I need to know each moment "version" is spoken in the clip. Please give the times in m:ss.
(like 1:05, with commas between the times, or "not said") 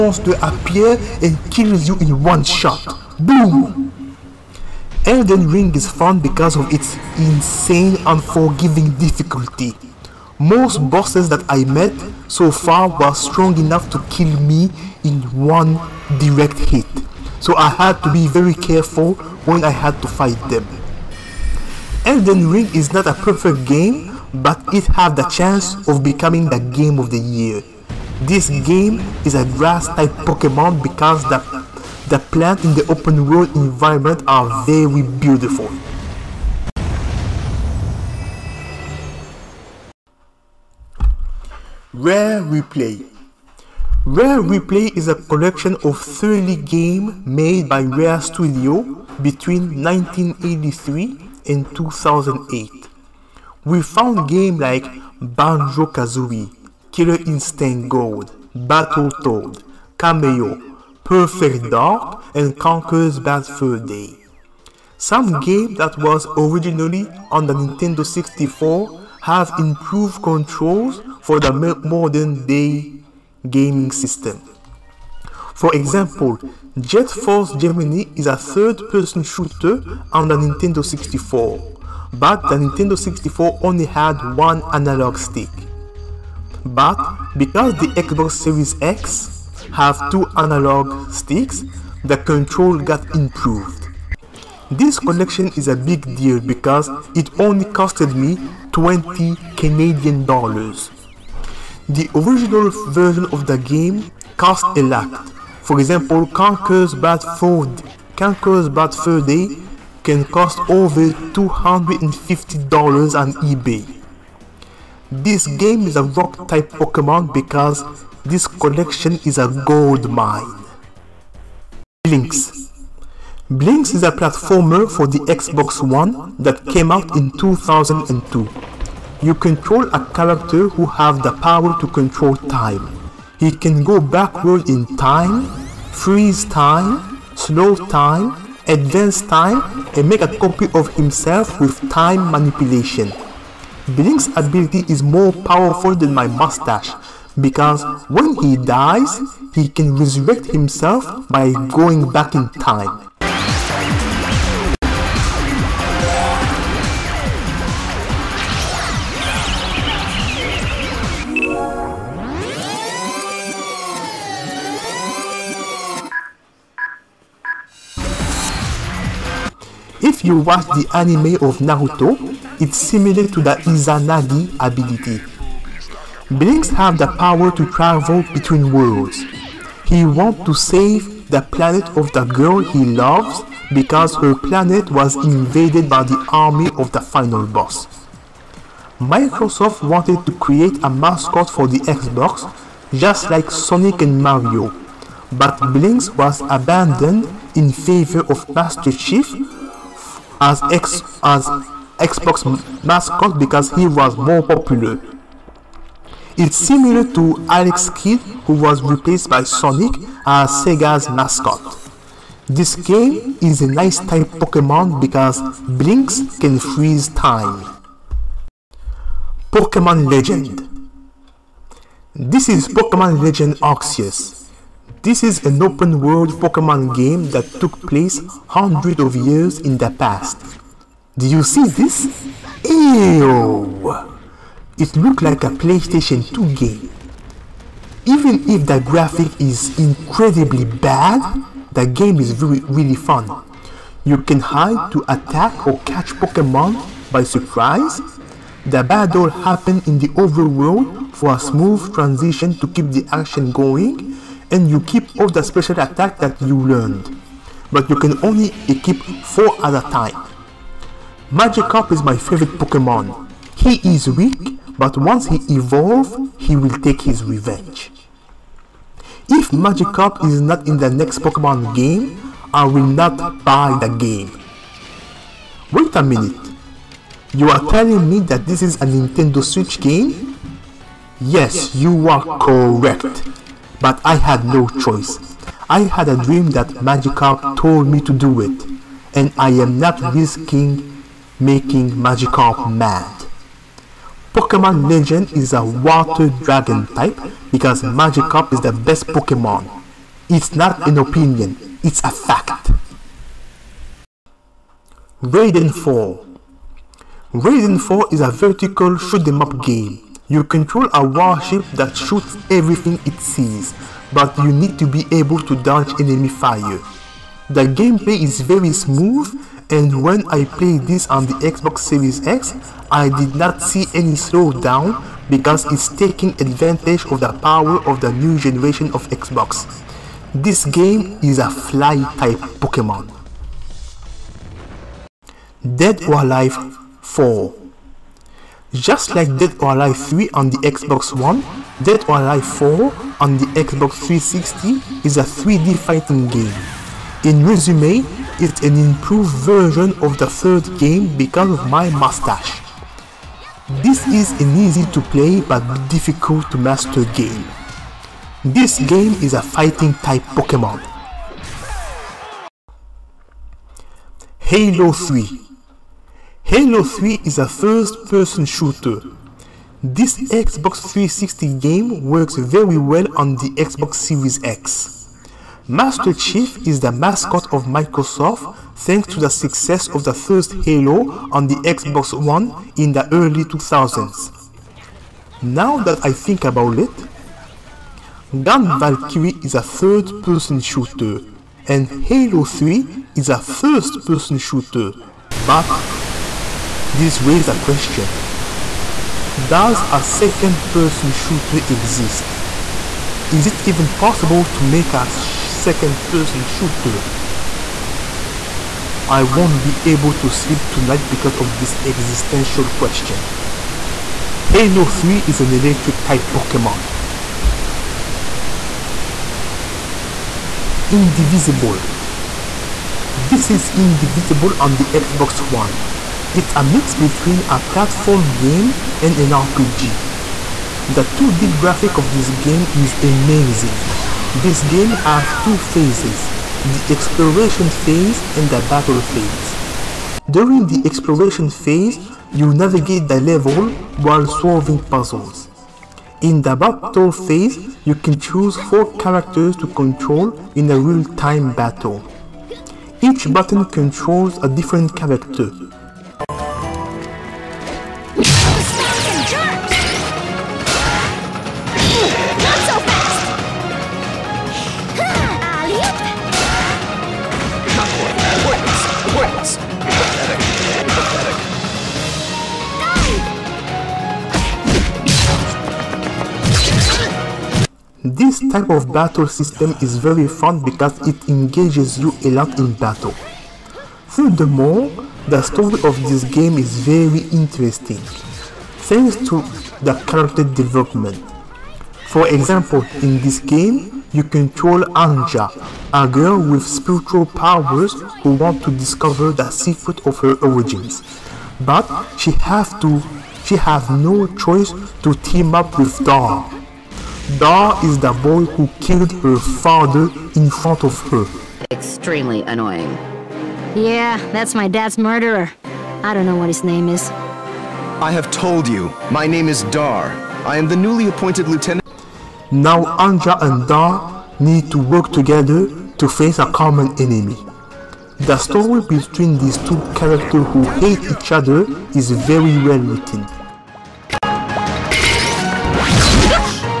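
1:42, 5:49.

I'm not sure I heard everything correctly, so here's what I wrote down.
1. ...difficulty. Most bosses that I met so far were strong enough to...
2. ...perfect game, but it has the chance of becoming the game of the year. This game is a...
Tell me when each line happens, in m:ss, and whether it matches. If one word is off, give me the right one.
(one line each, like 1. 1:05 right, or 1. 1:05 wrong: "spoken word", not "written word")
1. 0:08 right
2. 0:23 right.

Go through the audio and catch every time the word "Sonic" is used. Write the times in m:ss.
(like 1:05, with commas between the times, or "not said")
3:13, 3:29.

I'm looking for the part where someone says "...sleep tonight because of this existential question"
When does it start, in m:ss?
6:50.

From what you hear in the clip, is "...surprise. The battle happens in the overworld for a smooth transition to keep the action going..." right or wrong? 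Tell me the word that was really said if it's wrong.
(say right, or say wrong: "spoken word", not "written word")
right.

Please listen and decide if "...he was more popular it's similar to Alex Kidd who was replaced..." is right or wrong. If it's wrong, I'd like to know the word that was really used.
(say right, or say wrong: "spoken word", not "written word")
right.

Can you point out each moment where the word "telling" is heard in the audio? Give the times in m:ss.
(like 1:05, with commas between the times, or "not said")
4:37.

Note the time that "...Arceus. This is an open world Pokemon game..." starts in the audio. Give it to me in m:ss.
3:43.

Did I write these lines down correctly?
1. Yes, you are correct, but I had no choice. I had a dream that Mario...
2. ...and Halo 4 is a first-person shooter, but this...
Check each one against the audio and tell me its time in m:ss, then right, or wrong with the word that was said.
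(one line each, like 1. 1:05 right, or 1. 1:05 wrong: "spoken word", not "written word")
1. 4:41 wrong: "Magikarp", not "Mario"
2. 6:31 wrong: "3", not "4".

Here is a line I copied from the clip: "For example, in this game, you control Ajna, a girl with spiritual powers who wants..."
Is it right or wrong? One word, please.
right.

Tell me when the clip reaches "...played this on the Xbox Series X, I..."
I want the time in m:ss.
5:20.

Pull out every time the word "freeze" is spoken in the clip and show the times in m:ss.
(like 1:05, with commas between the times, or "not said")
2:15, 3:36.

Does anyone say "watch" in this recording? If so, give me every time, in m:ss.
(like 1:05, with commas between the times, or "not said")
2:50.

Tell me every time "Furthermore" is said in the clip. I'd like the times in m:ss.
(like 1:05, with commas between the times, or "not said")
8:04.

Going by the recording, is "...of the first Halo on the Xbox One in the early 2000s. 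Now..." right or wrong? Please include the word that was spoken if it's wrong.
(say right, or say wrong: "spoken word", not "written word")
right.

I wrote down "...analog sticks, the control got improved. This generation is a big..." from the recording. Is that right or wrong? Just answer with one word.
wrong.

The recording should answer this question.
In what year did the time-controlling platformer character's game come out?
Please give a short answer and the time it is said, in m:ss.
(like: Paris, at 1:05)
2002, at 2:07.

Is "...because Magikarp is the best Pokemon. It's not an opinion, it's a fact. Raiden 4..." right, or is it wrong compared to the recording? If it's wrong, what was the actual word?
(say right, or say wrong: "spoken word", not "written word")
right.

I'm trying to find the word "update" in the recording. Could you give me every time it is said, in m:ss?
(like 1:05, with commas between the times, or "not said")
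not said.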